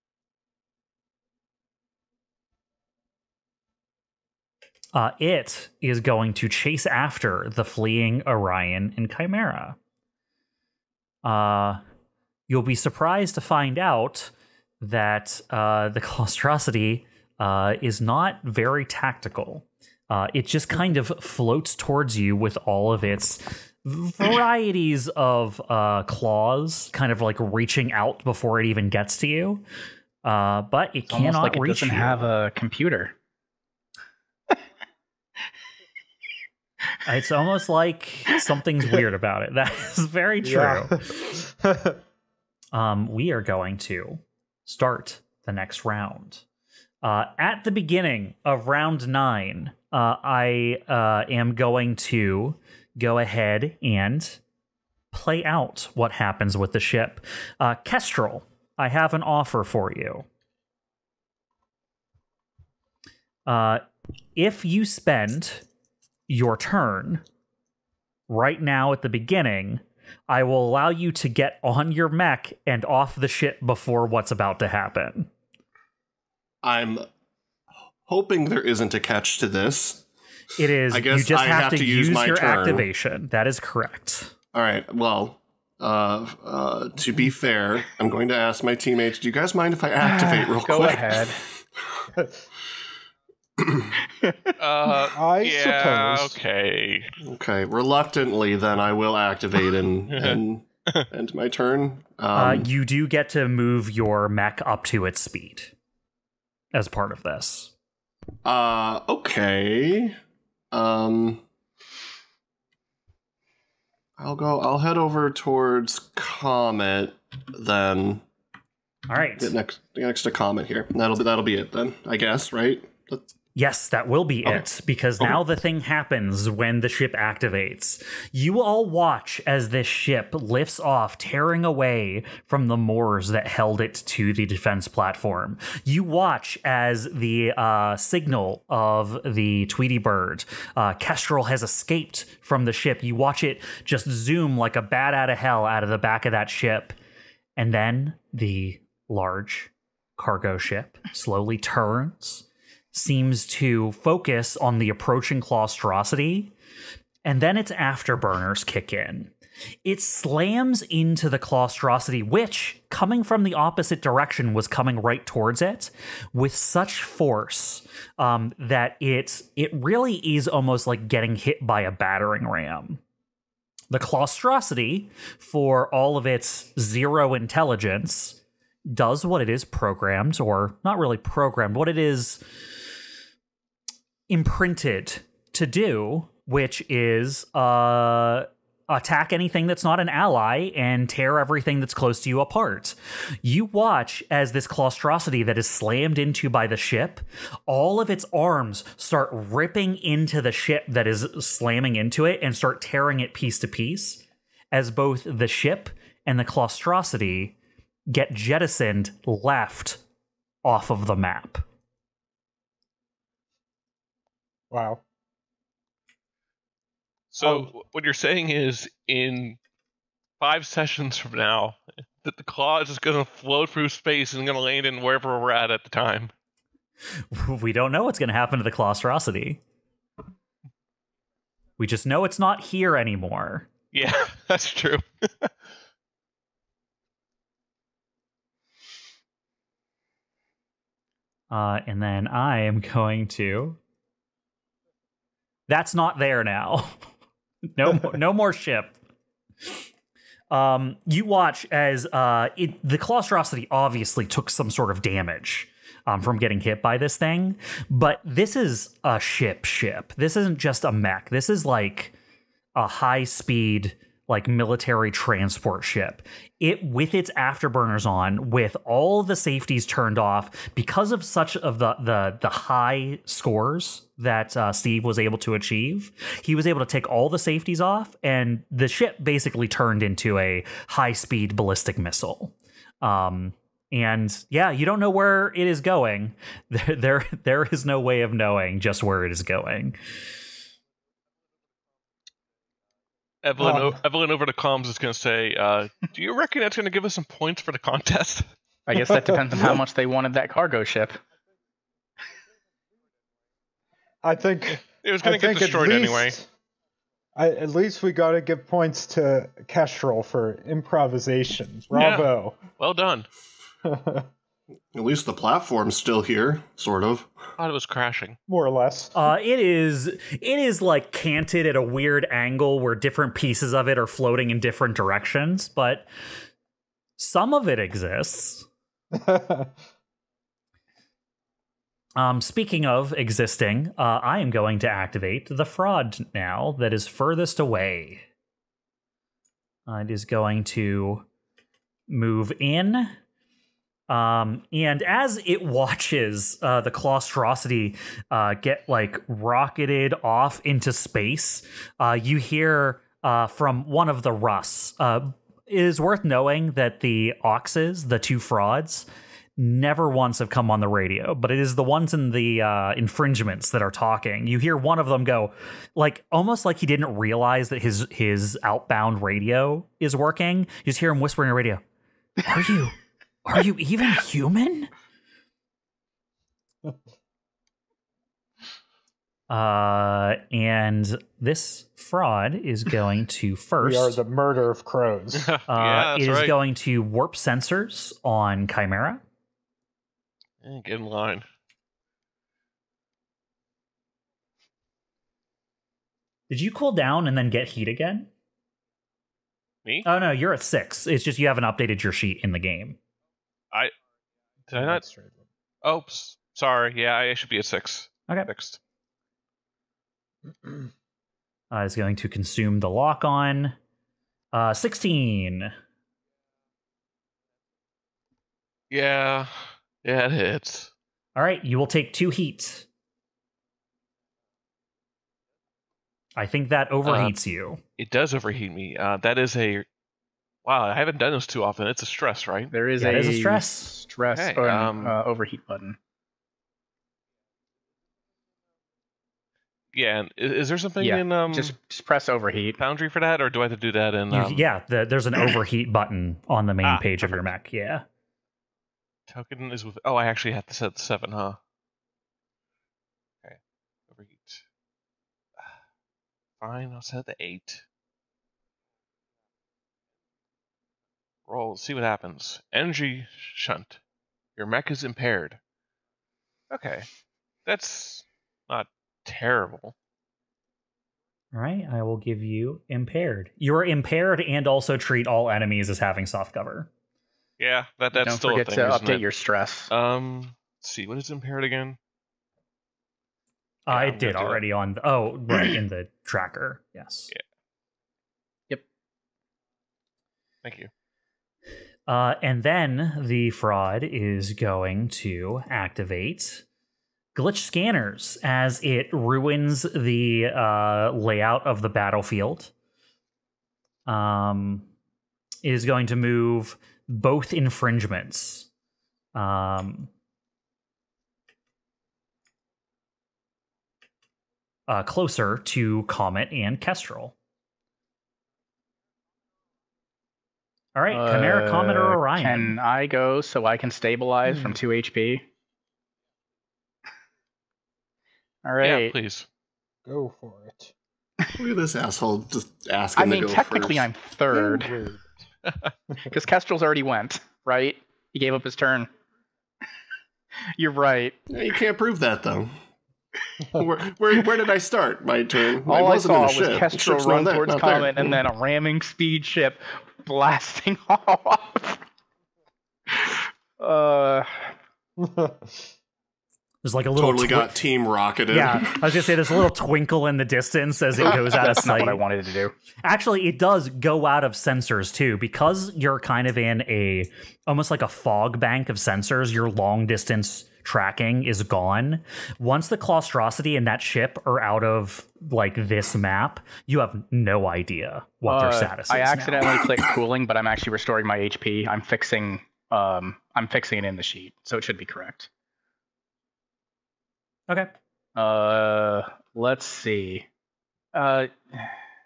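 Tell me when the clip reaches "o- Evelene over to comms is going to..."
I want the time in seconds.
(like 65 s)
293 s.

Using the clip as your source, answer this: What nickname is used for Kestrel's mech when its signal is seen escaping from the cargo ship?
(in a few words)
Tweety Bird.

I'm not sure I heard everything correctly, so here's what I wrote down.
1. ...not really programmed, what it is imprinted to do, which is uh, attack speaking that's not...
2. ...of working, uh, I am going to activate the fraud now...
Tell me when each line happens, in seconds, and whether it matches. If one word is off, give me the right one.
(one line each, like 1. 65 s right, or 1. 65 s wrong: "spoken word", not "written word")
1. 180 s wrong: "anything", not "speaking"
2. 332 s wrong: "existing", not "working".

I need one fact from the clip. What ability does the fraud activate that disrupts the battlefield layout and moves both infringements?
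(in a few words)
glitch scanners.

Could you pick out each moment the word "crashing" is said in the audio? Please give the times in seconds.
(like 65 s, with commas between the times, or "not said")
317 s.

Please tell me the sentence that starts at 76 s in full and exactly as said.
I'm hoping there isn't a catch to this.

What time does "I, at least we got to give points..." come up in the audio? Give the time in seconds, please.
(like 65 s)
307 s.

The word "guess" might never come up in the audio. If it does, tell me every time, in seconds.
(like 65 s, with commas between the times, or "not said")
81 s, 122 s, 298 s.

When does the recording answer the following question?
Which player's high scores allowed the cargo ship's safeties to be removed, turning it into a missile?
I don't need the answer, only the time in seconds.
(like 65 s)
274 s.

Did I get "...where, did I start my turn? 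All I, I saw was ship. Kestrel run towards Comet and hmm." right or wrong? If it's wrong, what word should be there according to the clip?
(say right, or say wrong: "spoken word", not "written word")
right.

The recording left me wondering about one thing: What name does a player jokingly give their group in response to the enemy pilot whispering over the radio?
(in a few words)
the murder of crows.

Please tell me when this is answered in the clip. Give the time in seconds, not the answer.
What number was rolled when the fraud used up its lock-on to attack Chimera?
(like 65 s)
414 s.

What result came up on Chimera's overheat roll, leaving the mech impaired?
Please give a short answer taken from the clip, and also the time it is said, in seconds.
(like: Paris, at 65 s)
Energy shunt, at 462 s.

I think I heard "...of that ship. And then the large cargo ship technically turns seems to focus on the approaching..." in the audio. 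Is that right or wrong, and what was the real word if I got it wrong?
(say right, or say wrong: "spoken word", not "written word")
wrong: "slowly", not "technically".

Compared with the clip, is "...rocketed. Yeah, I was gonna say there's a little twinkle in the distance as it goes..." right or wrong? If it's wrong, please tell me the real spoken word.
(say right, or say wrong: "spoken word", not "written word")
right.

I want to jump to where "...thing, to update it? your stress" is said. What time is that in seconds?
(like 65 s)
478 s.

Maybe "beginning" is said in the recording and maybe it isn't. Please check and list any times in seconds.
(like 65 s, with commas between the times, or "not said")
47 s, 69 s.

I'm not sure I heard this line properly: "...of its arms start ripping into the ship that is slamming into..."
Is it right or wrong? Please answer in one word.
right.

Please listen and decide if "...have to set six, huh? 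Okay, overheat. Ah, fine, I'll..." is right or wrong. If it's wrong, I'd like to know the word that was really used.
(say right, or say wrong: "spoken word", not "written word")
wrong: "seven", not "six".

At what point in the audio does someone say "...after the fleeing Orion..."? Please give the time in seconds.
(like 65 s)
6 s.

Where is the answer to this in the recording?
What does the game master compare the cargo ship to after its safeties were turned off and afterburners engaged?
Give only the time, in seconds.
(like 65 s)
281 s.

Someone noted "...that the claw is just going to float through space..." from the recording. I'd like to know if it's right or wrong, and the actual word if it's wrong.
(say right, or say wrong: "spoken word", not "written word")
right.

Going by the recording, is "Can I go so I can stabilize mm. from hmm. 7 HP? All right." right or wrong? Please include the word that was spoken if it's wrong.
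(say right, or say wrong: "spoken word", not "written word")
wrong: "2", not "7".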